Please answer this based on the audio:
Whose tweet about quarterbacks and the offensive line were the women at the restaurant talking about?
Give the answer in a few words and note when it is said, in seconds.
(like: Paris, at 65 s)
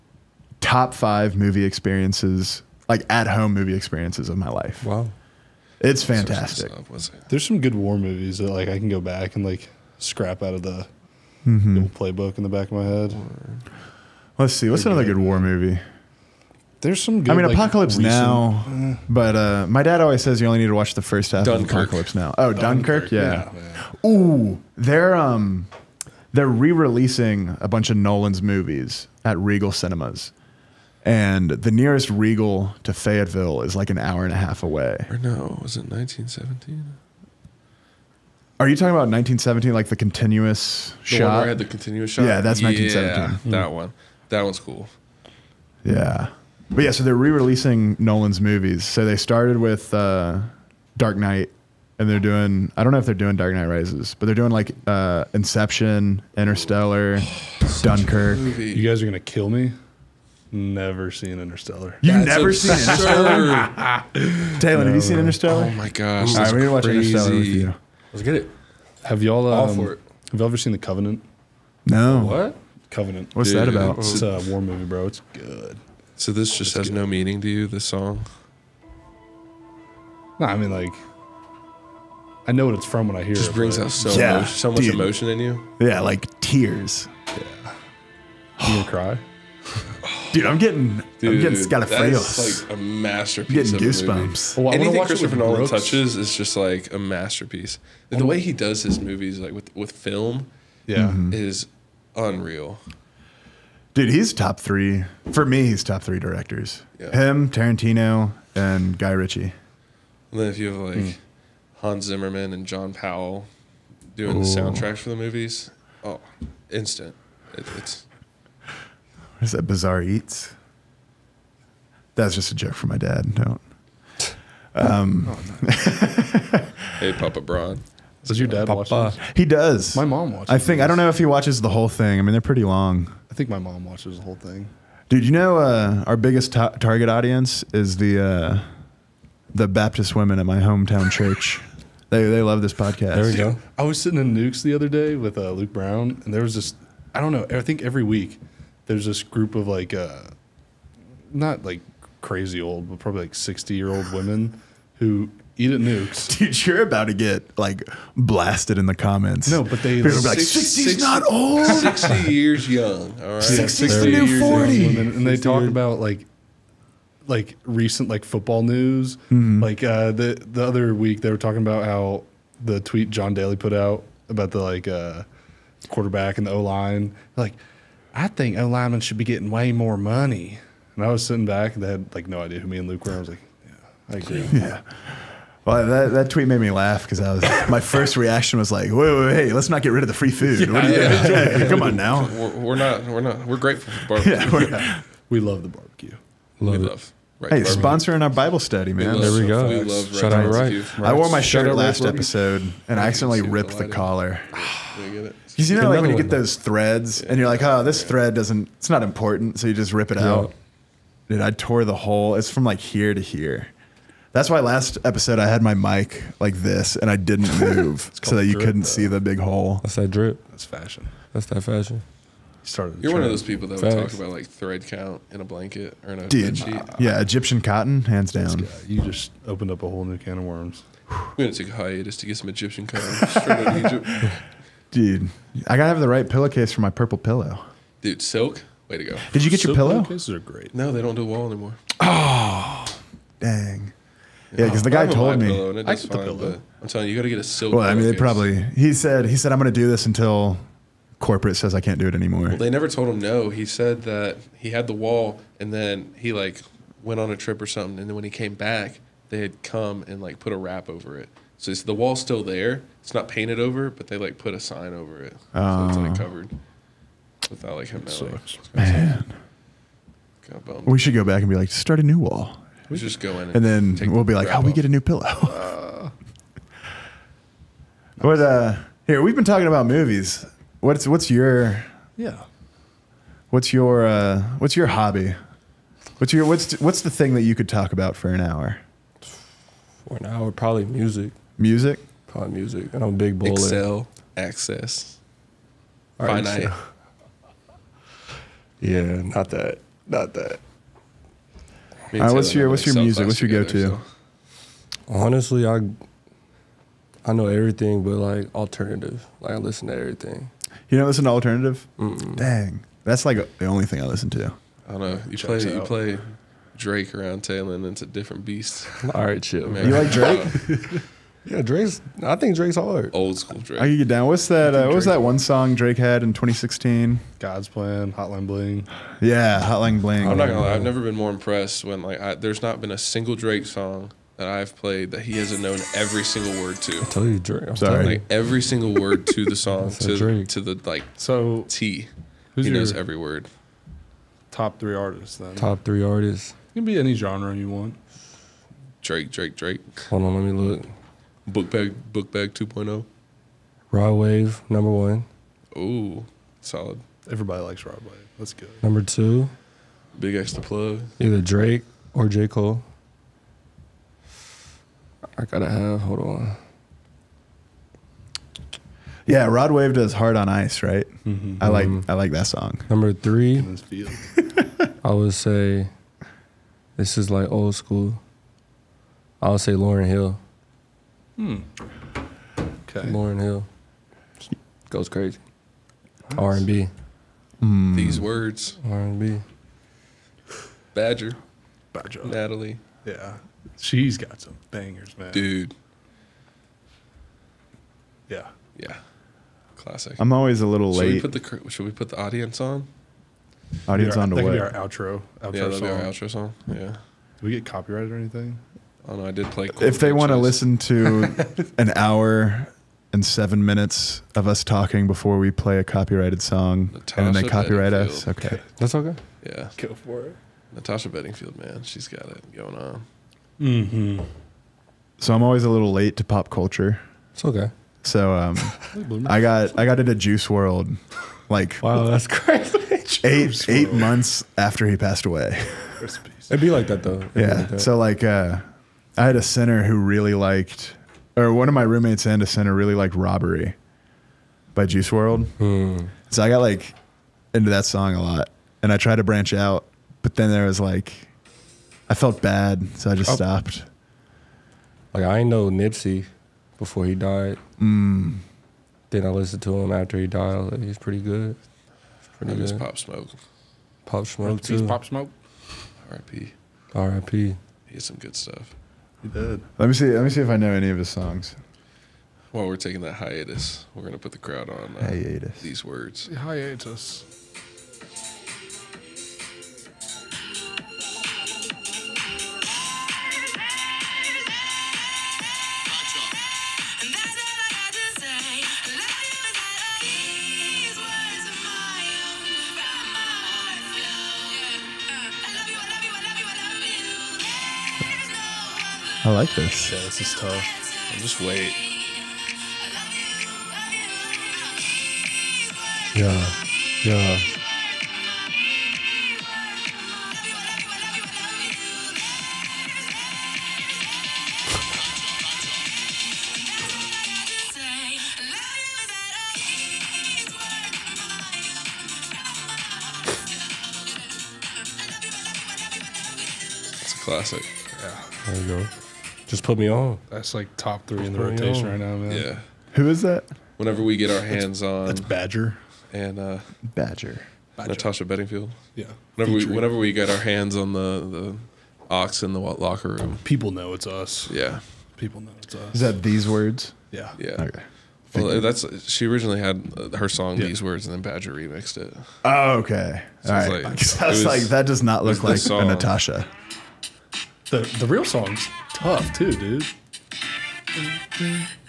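John Daly, at 173 s.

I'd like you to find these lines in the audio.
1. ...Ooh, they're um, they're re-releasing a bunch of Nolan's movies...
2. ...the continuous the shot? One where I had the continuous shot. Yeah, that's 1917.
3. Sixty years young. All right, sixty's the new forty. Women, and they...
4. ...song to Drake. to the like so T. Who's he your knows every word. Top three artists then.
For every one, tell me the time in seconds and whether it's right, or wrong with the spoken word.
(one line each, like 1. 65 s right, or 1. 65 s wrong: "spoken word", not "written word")
1. 24 s right
2. 39 s right
3. 161 s right
4. 339 s right.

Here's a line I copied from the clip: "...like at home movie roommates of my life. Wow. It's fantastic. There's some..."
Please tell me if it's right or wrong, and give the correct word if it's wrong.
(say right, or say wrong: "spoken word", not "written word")
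wrong: "experiences", not "roommates".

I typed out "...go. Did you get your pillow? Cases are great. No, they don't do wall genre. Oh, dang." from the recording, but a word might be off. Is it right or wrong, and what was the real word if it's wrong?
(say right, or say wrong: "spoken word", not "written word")
wrong: "anymore", not "genre".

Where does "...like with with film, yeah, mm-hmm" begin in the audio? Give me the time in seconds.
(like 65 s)
99 s.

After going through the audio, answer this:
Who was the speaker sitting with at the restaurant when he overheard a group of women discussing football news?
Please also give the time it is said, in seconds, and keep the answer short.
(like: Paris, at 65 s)
Luke Brown, at 145 s.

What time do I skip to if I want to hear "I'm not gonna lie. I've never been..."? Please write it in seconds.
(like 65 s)
330 s.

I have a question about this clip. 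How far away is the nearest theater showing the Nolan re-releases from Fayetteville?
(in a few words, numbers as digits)
an hour and a half.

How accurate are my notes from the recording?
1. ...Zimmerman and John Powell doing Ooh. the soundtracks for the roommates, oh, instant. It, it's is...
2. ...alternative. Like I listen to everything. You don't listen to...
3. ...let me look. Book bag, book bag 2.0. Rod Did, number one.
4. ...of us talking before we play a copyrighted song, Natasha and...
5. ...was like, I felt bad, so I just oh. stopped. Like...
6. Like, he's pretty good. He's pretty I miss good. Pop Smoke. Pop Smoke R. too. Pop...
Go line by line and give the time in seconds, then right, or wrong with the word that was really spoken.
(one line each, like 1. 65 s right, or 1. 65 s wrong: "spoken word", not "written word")
1. 112 s wrong: "movies", not "roommates"
2. 308 s right
3. 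350 s wrong: "Wave", not "Did"
4. 414 s right
5. 450 s right
6. 460 s right.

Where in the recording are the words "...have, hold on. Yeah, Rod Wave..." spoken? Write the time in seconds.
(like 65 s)
365 s.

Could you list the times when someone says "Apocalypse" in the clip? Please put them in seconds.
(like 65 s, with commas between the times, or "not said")
17 s, 21 s.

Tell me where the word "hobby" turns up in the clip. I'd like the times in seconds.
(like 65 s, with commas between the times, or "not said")
284 s.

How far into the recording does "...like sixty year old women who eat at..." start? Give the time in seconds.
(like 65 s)
153 s.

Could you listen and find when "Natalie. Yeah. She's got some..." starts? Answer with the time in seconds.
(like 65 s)
392 s.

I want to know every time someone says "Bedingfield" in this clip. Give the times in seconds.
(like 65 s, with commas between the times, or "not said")
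421 s, 538 s.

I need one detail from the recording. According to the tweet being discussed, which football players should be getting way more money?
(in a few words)
O linemen.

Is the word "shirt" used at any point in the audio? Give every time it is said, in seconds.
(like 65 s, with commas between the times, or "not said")
201 s.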